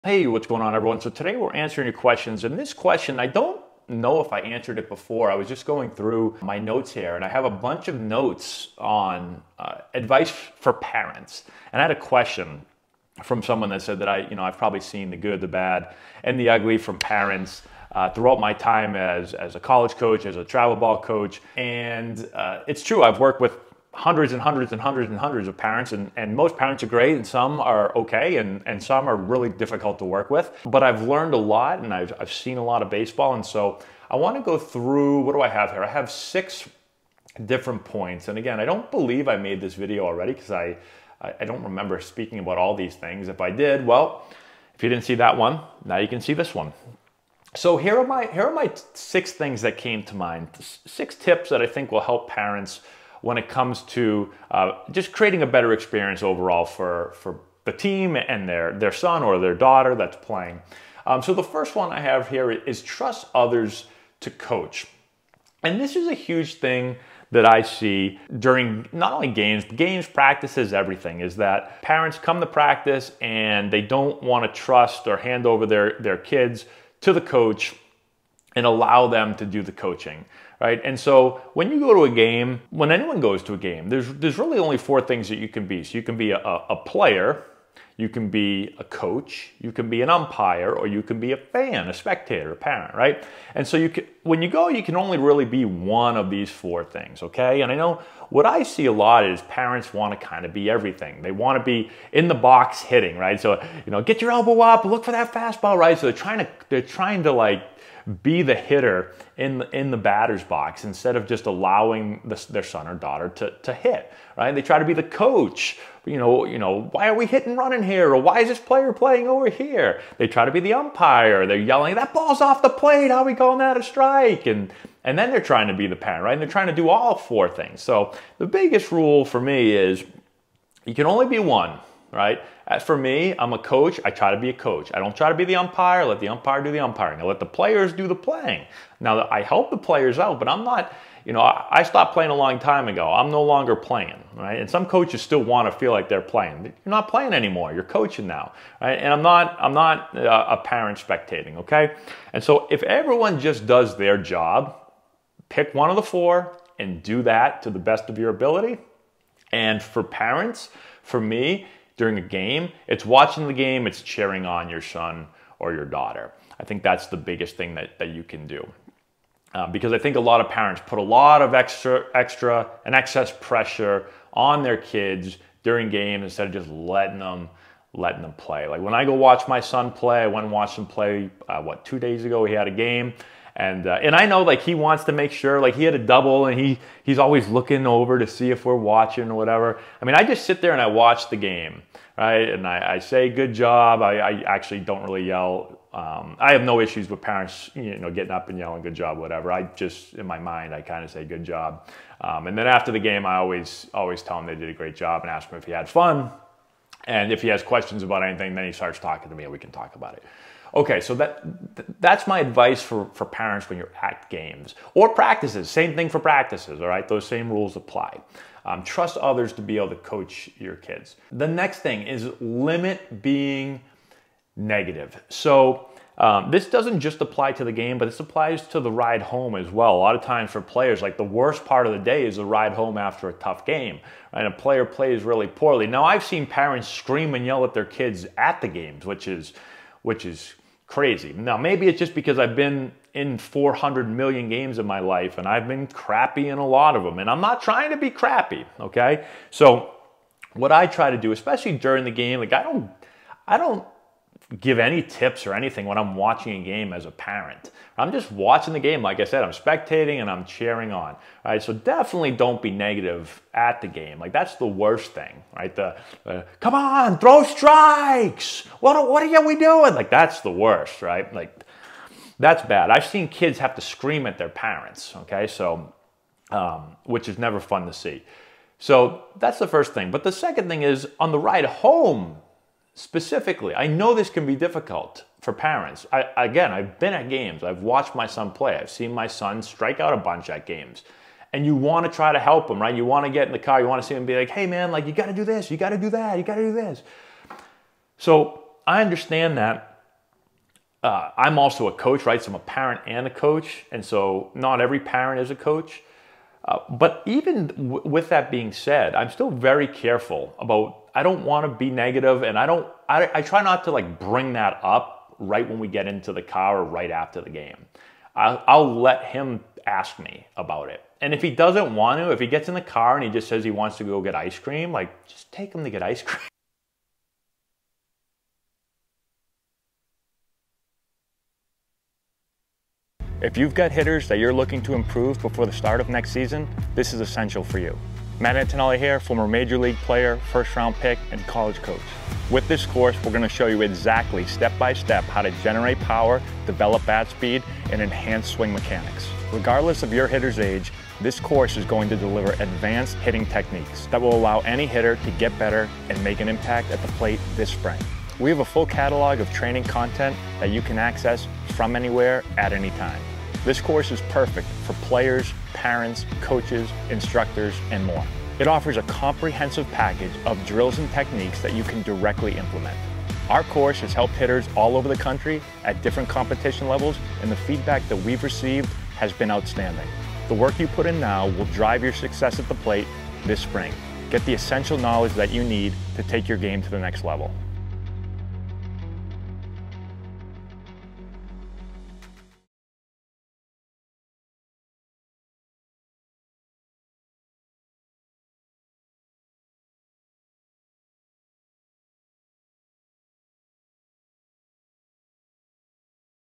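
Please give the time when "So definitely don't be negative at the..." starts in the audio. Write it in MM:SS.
04:21.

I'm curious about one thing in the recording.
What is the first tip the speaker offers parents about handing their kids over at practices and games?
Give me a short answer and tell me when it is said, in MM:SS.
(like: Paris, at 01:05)
Trust others to coach, at 01:02.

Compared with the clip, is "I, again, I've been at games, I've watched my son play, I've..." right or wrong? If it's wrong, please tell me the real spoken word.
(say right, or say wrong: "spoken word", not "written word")
right.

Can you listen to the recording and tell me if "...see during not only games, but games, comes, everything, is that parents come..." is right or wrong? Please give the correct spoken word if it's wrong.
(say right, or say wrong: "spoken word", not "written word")
wrong: "practices", not "comes".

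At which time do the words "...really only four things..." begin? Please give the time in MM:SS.
01:24.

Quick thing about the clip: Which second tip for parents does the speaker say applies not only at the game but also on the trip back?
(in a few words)
Limit being negative.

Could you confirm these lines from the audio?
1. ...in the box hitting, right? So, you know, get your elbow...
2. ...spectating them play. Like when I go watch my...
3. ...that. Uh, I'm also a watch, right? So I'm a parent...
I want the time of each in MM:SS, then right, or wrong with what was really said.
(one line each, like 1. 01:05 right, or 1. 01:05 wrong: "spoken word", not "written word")
1. 01:42 right
2. 02:57 wrong: "letting", not "spectating"
3. 04:59 wrong: "coach", not "watch".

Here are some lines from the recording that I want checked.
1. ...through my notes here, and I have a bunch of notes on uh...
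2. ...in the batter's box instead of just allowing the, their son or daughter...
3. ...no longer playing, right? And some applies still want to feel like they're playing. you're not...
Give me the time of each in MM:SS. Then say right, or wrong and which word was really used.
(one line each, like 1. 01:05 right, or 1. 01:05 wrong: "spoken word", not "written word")
1. 00:05 right
2. 01:49 right
3. 02:23 wrong: "coaches", not "applies".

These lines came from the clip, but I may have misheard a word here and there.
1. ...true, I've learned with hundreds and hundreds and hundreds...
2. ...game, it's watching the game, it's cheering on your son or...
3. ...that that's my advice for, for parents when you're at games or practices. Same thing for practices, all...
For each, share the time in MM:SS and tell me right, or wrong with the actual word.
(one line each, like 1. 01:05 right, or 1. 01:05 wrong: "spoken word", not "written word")
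1. 00:22 wrong: "worked", not "learned"
2. 02:42 right
3. 03:31 right.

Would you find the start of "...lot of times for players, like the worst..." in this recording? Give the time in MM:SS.
03:49.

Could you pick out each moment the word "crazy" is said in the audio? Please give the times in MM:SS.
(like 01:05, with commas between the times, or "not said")
04:00.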